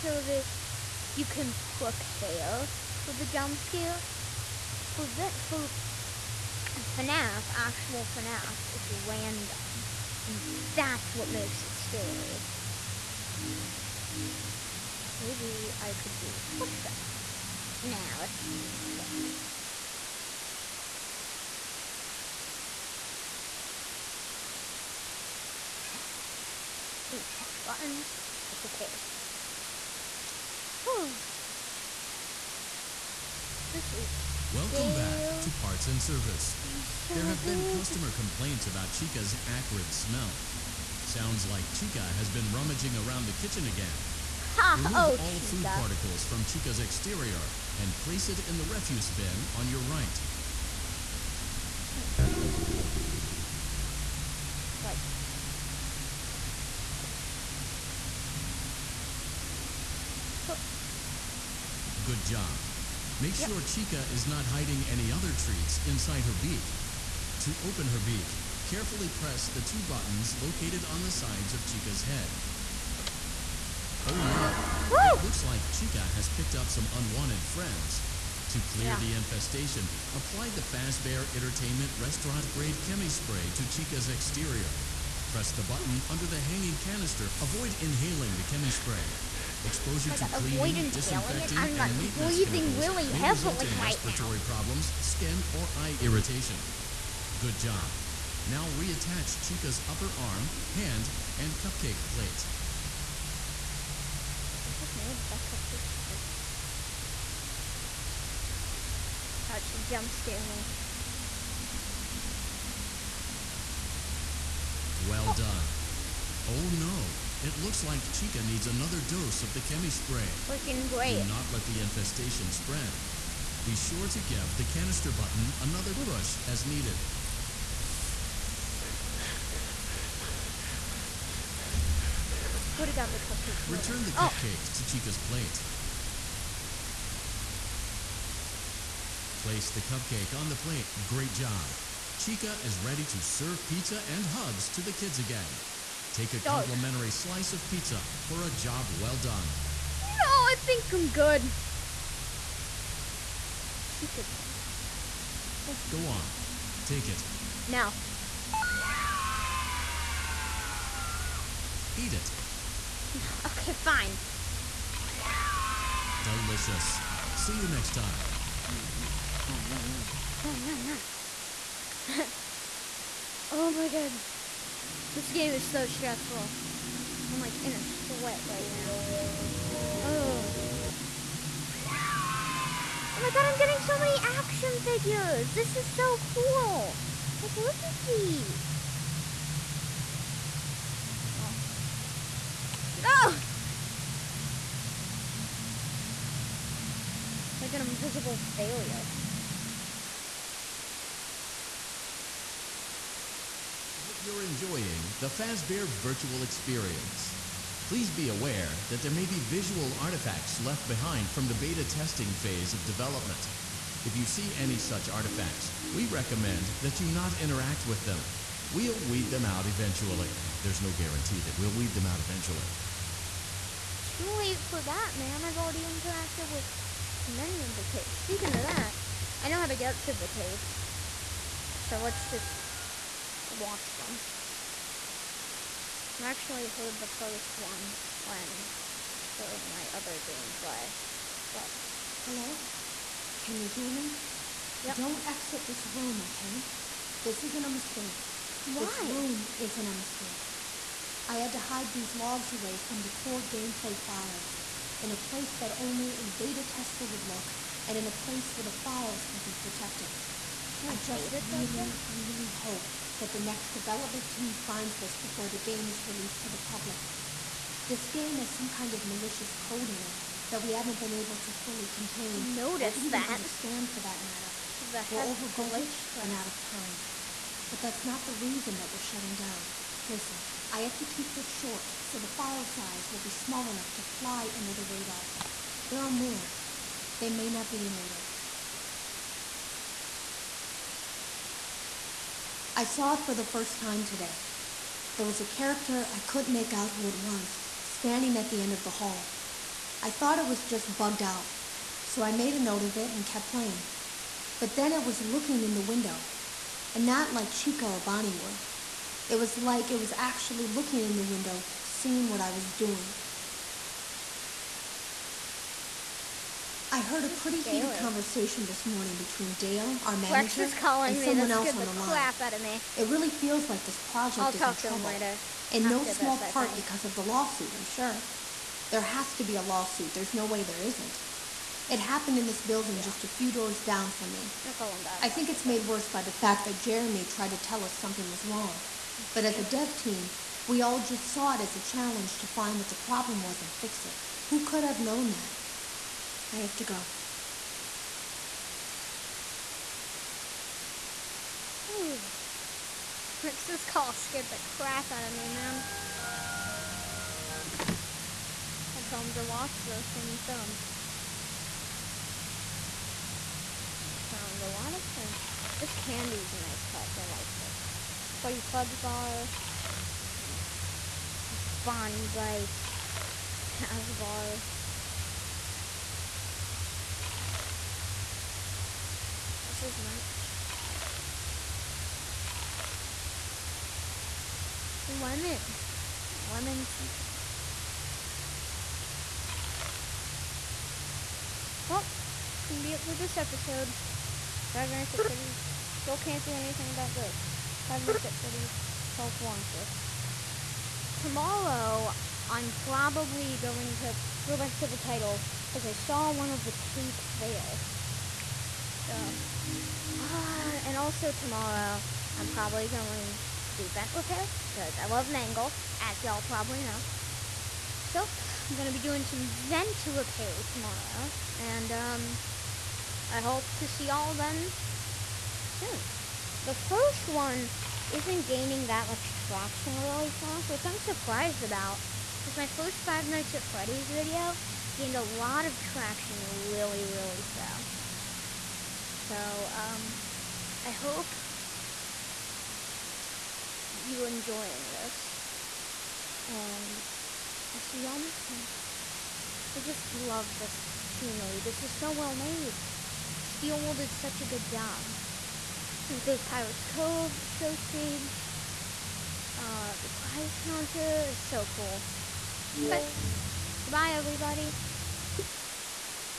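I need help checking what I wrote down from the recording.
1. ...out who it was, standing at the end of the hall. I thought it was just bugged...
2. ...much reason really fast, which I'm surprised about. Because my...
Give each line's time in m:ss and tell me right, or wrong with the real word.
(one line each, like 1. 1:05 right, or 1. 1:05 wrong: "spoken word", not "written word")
1. 4:56 right
2. 7:09 wrong: "traction", not "reason".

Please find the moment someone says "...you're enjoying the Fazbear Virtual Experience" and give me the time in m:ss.
3:24.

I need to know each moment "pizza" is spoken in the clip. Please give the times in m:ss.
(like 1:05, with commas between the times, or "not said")
2:23, 2:27.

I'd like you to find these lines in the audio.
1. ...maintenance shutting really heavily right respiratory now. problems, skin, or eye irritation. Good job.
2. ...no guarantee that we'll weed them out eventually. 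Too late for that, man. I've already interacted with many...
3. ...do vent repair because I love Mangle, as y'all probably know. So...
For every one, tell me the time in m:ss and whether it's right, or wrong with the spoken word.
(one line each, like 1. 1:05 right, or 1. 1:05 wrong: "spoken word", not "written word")
1. 1:31 wrong: "breathing", not "shutting"
2. 3:40 right
3. 6:53 right.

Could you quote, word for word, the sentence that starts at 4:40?
Listen, I have to keep this short so the file size will be small enough to fly under the radar.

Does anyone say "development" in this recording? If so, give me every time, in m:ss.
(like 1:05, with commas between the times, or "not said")
3:32, 4:23.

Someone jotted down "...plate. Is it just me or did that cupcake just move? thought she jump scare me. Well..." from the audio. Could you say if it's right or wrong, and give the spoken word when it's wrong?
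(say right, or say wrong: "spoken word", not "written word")
right.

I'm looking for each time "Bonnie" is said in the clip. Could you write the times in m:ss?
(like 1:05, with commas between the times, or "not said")
5:07, 6:11.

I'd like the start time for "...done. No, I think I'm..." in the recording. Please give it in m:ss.
2:29.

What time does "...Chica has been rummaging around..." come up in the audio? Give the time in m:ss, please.
0:41.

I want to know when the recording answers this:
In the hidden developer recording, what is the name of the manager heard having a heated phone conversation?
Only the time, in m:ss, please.
5:19.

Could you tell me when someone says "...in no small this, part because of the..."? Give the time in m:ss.
5:25.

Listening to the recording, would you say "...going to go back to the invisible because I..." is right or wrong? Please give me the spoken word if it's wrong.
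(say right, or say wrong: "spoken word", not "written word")
wrong: "title", not "invisible".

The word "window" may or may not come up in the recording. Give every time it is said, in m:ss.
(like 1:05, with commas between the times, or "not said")
5:05, 5:11.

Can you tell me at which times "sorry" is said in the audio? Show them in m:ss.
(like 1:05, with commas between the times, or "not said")
not said.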